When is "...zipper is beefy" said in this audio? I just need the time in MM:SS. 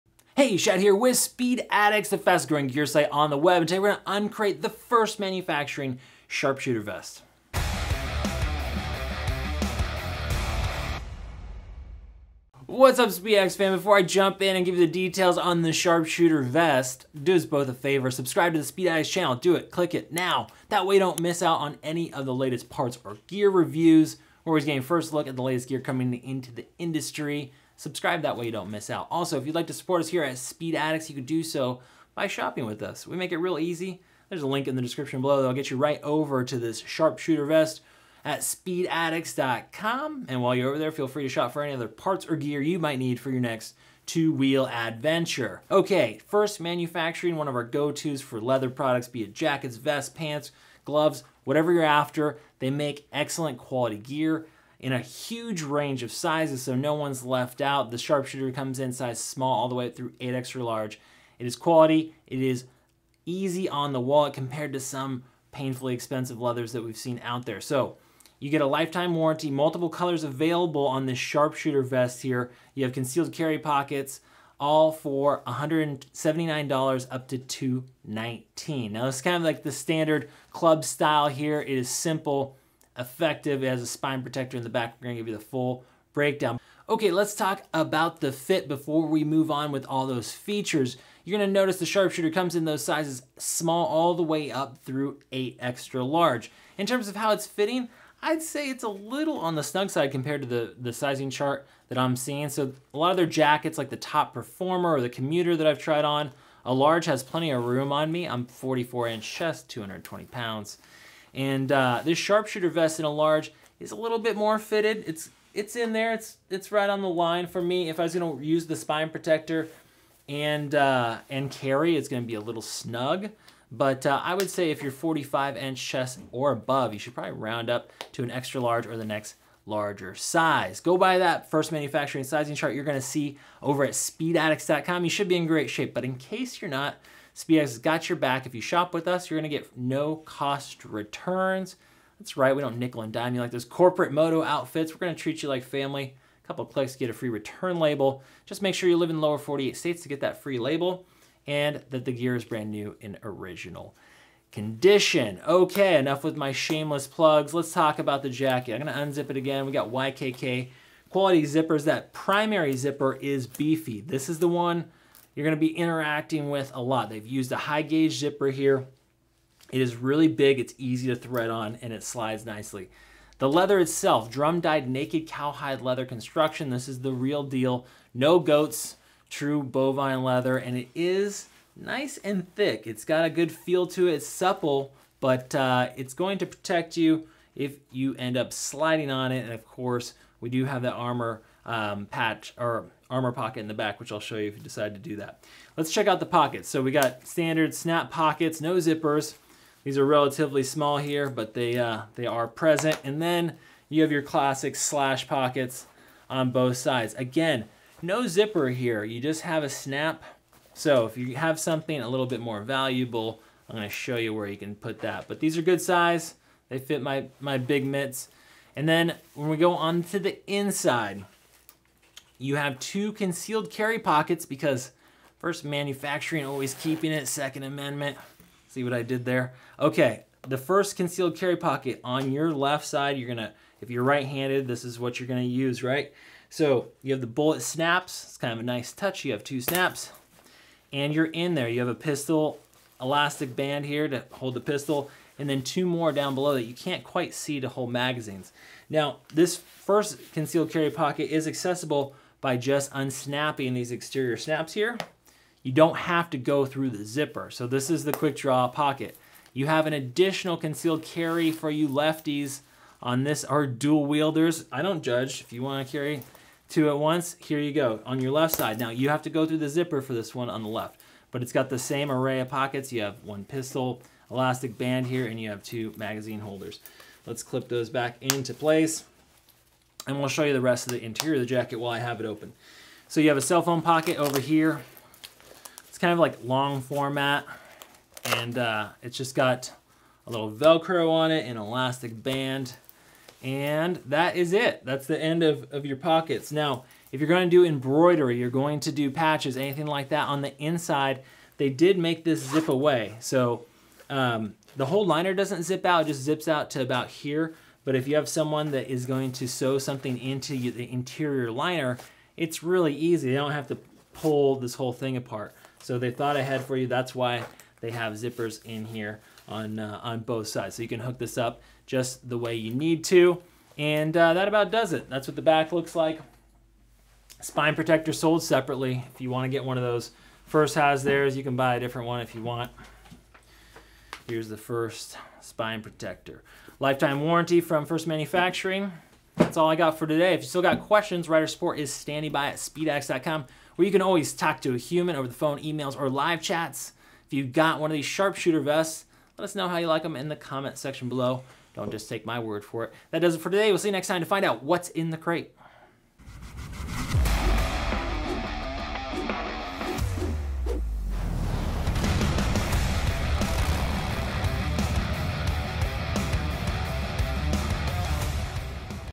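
02:42.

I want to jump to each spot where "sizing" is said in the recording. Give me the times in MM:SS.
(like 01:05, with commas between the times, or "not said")
01:40, 02:12.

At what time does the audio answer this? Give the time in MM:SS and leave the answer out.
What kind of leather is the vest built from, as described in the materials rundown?
02:54.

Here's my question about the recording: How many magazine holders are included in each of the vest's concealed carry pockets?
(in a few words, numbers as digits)
2.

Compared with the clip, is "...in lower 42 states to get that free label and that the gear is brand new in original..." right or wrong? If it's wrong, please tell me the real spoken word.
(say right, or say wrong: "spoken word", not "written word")
wrong: "48", not "42".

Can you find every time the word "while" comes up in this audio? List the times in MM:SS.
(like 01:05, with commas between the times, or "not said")
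00:40, 04:41.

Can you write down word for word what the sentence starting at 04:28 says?
Now you have to go through the zipper for this one on the left, but it's got the same array of pockets.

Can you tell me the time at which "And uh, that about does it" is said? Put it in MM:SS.
05:23.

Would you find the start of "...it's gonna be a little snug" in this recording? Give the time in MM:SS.
02:01.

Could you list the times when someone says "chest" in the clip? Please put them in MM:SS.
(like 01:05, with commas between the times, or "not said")
01:49, 02:05.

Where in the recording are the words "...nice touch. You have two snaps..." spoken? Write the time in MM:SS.
03:58.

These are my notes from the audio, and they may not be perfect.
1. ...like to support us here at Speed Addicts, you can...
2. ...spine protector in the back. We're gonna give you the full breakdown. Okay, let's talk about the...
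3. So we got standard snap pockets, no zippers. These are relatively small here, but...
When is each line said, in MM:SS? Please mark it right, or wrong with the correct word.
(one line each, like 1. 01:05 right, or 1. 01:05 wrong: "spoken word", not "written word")
1. 00:29 right
2. 01:23 right
3. 03:16 right.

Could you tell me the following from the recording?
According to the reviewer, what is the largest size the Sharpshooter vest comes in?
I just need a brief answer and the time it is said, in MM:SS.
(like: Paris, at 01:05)
8XL, at 01:00.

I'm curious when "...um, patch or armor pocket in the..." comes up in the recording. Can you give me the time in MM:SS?
03:11.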